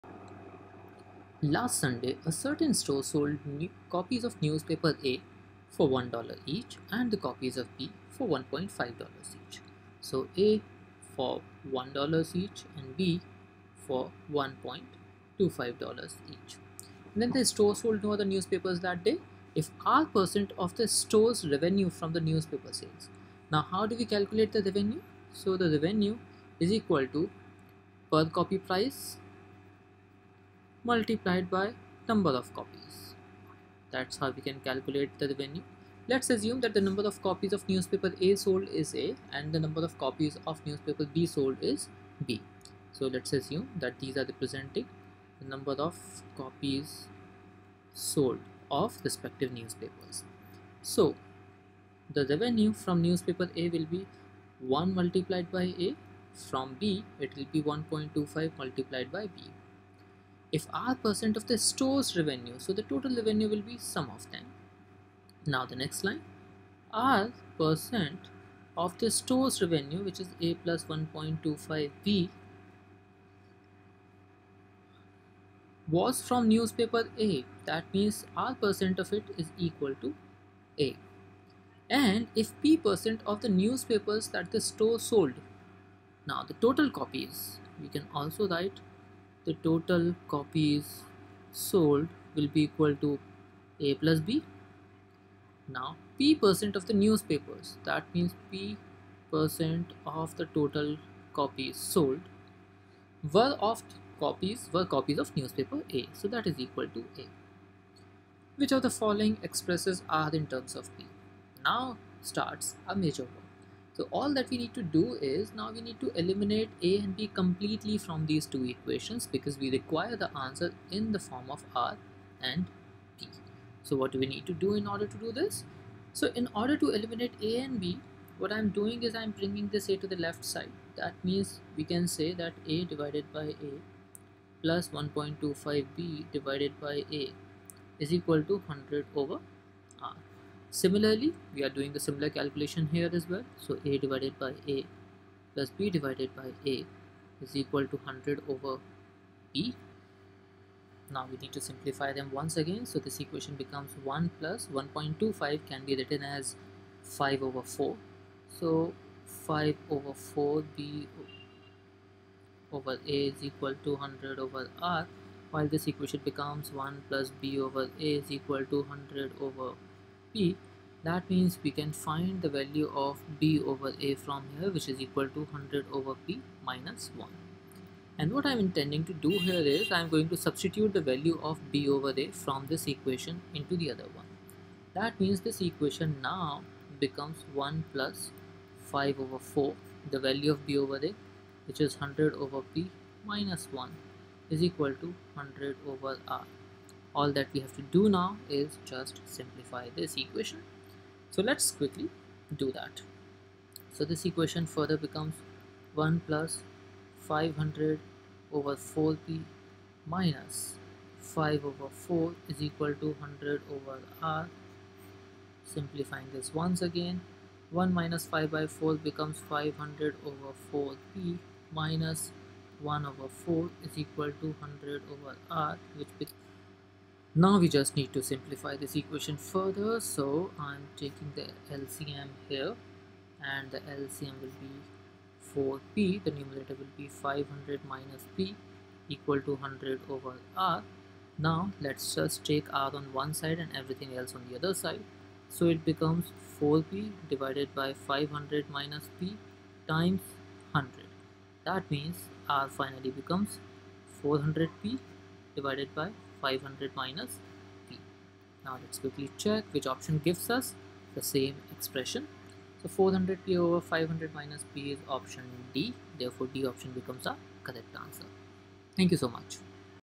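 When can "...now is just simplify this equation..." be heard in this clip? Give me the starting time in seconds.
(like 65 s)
198 s.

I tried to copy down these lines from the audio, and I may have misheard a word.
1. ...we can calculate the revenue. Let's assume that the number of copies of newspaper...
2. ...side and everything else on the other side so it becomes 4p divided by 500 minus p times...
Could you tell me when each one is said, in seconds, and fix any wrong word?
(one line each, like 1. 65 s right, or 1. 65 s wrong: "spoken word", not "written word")
1. 34 s right
2. 243 s right.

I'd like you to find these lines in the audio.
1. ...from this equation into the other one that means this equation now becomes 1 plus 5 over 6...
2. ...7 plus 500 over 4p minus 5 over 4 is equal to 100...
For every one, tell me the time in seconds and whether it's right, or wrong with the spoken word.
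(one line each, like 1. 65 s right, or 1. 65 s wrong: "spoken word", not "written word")
1. 182 s wrong: "4", not "6"
2. 205 s wrong: "1", not "7".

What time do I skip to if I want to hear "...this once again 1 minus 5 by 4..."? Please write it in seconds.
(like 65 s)
216 s.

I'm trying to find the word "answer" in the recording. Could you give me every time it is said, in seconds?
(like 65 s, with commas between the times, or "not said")
120 s, 268 s.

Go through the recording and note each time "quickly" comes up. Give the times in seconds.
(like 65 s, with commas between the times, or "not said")
201 s, 258 s.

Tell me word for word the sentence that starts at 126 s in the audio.
So in order to eliminate A and B, what I'm doing is I'm bringing this A to the left side.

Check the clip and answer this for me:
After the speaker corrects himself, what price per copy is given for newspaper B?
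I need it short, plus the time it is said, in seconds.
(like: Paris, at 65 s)
$1.25, at 12 s.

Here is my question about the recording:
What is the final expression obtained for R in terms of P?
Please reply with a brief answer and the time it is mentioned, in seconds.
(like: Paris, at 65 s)
400P/(500 - P), at 254 s.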